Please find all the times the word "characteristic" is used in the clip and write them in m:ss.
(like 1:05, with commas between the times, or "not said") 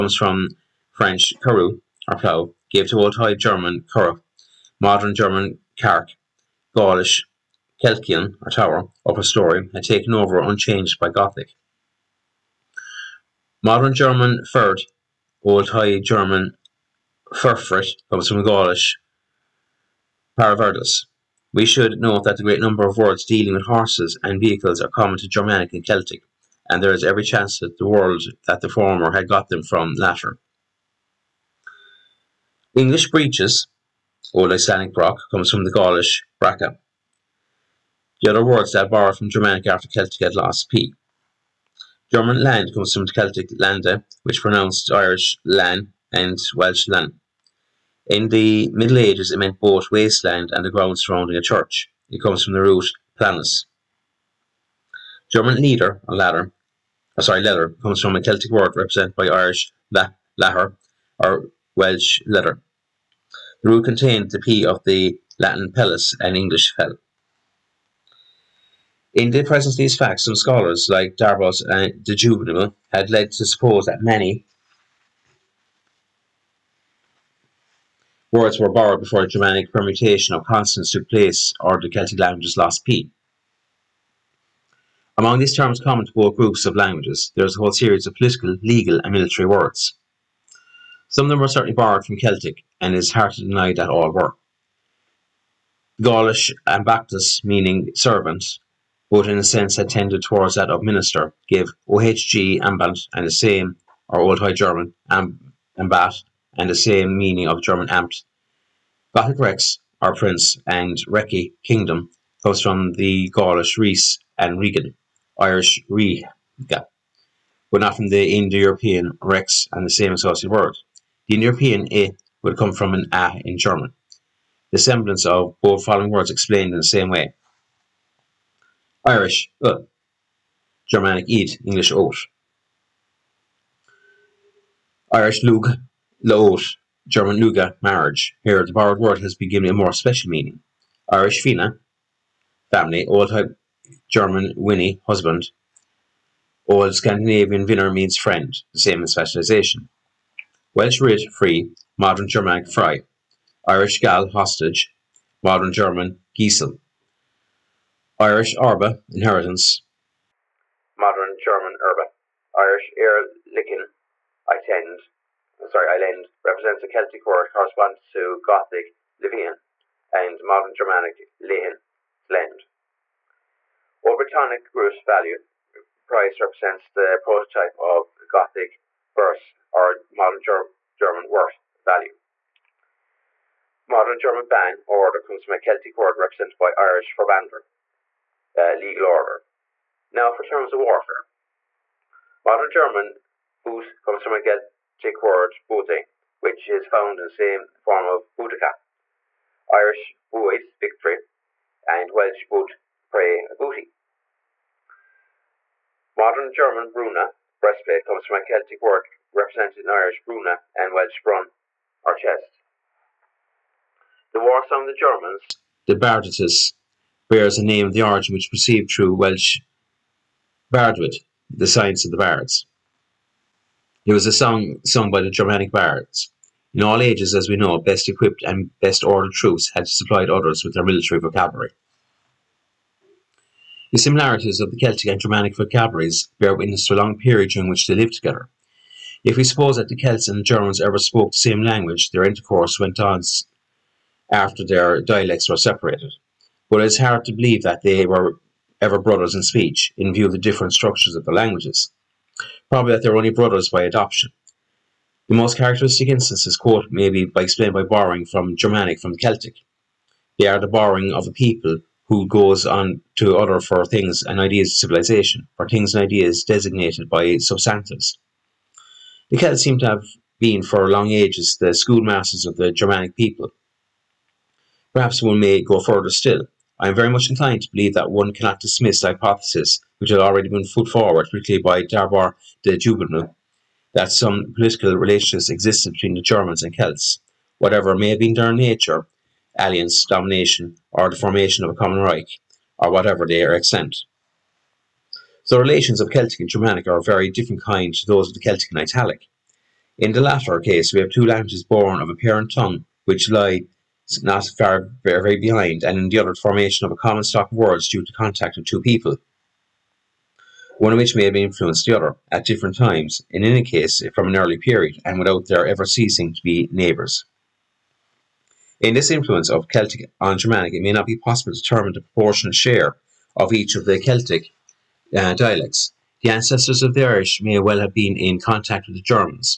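4:15.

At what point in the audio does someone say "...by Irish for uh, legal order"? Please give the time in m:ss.
3:06.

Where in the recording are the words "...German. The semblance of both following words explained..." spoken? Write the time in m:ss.
2:03.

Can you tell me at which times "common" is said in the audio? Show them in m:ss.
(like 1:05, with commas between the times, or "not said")
0:24, 1:25, 4:51, 5:06.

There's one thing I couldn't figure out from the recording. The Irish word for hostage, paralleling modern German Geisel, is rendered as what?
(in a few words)
Gal.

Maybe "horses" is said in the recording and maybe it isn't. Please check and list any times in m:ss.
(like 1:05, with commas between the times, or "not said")
0:23.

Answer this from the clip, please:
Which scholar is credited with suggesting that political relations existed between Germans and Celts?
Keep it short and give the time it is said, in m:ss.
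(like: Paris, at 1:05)
d'Arbois de Jubainville, at 4:41.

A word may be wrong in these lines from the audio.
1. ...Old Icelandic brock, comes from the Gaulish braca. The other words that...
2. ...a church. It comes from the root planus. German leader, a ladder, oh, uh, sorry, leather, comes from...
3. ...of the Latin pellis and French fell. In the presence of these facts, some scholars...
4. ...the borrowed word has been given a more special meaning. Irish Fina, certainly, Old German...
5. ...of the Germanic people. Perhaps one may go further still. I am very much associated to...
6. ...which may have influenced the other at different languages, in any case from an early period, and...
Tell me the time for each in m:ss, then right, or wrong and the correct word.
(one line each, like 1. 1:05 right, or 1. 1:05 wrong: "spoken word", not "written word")
1. 0:34 right
2. 0:51 right
3. 1:04 wrong: "English", not "French"
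4. 2:18 wrong: "family", not "certainly"
5. 4:32 wrong: "inclined", not "associated"
6. 5:10 wrong: "times", not "languages".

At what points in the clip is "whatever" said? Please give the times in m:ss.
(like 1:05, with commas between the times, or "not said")
4:47, 4:52.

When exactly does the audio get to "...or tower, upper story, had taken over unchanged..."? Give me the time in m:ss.
0:08.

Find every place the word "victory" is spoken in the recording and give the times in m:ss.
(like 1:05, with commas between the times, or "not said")
3:20.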